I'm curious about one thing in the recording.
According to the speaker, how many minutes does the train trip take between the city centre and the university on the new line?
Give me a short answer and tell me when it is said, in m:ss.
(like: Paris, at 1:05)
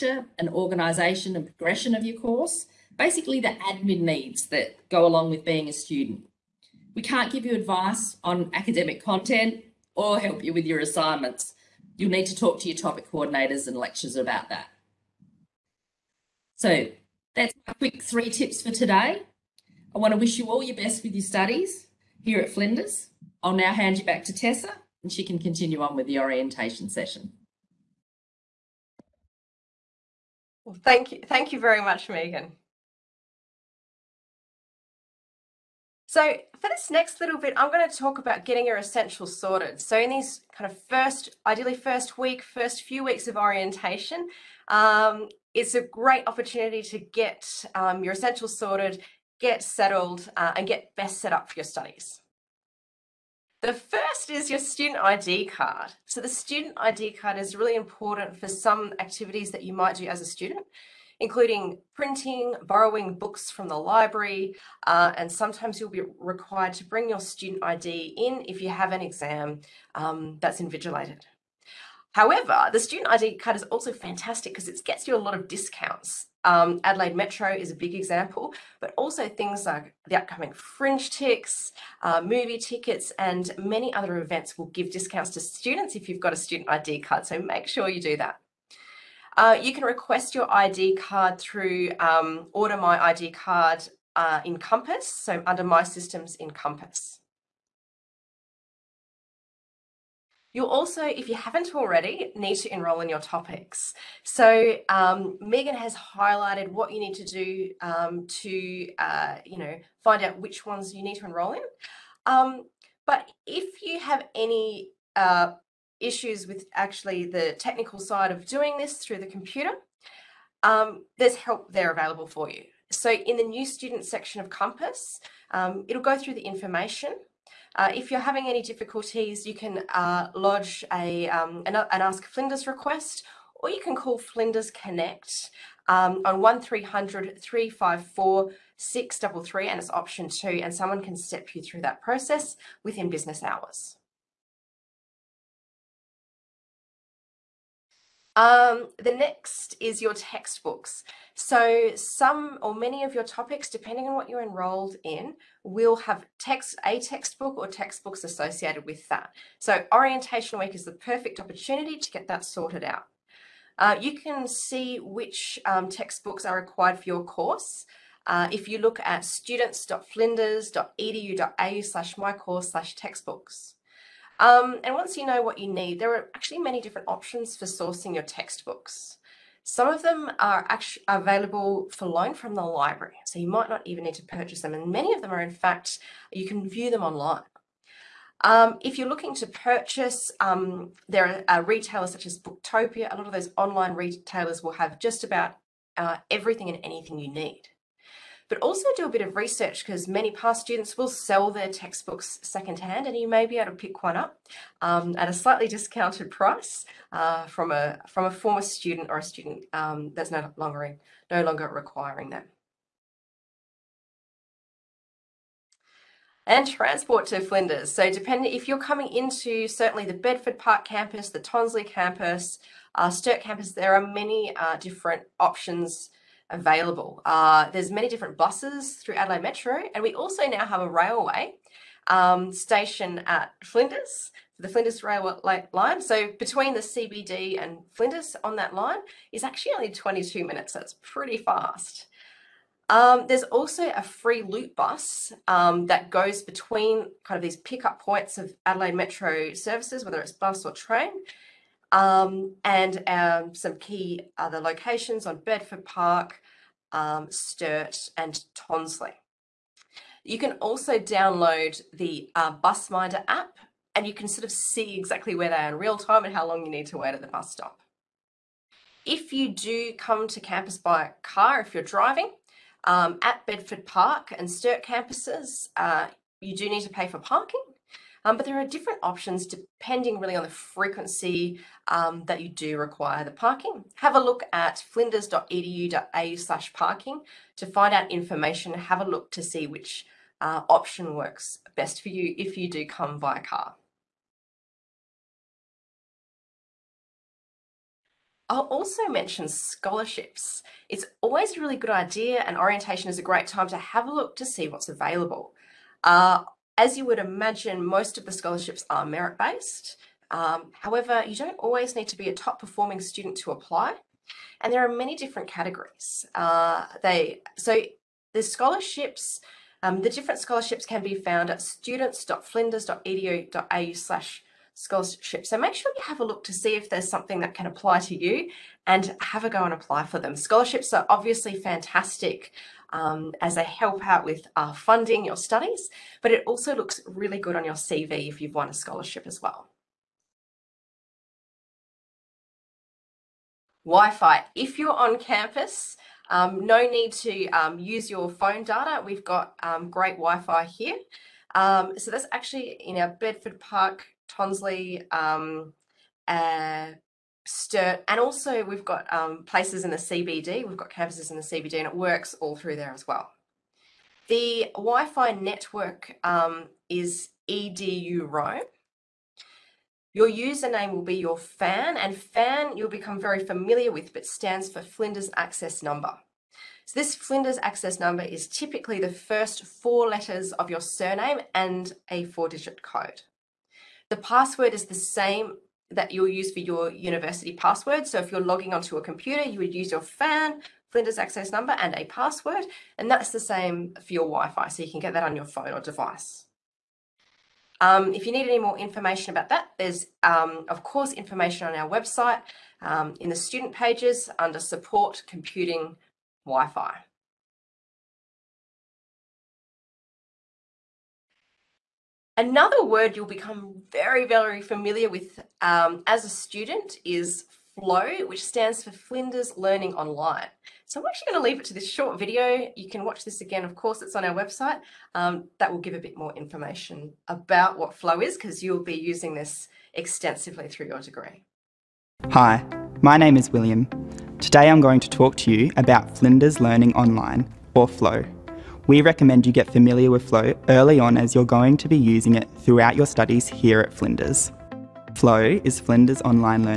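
22, at 3:59.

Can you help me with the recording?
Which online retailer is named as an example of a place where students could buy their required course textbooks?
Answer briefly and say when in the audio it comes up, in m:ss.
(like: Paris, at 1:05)
Booktopia, at 3:12.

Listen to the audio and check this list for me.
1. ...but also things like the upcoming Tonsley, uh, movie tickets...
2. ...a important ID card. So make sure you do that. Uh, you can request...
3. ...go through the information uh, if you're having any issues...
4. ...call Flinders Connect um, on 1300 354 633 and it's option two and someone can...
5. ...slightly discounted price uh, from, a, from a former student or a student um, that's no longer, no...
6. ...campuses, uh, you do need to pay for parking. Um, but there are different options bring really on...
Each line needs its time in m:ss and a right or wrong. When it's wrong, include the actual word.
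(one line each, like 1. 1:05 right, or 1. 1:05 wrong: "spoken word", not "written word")
1. 1:18 wrong: "FringeTIX", not "Tonsley"
2. 1:26 wrong: "student", not "important"
3. 2:06 wrong: "difficulties", not "issues"
4. 2:13 right
5. 3:25 right
6. 4:34 wrong: "depending", not "bring".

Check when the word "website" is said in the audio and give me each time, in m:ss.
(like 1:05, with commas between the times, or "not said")
6:41, 7:04.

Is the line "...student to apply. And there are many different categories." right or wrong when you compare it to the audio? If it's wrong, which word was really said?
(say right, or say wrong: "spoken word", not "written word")
right.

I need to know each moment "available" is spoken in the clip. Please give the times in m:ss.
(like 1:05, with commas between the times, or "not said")
2:01, 3:01, 3:46, 5:04.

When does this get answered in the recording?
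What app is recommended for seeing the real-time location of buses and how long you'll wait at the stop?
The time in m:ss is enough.
4:22.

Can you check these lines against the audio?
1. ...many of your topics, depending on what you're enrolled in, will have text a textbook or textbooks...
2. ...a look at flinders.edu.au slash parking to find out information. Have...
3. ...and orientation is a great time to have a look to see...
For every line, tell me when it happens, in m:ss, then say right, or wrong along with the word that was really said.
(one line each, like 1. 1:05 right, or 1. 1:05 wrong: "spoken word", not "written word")
1. 2:32 right
2. 4:44 right
3. 5:02 right.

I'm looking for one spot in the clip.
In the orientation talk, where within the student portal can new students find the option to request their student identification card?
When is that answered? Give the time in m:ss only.
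1:35.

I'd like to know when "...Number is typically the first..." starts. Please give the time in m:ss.
6:17.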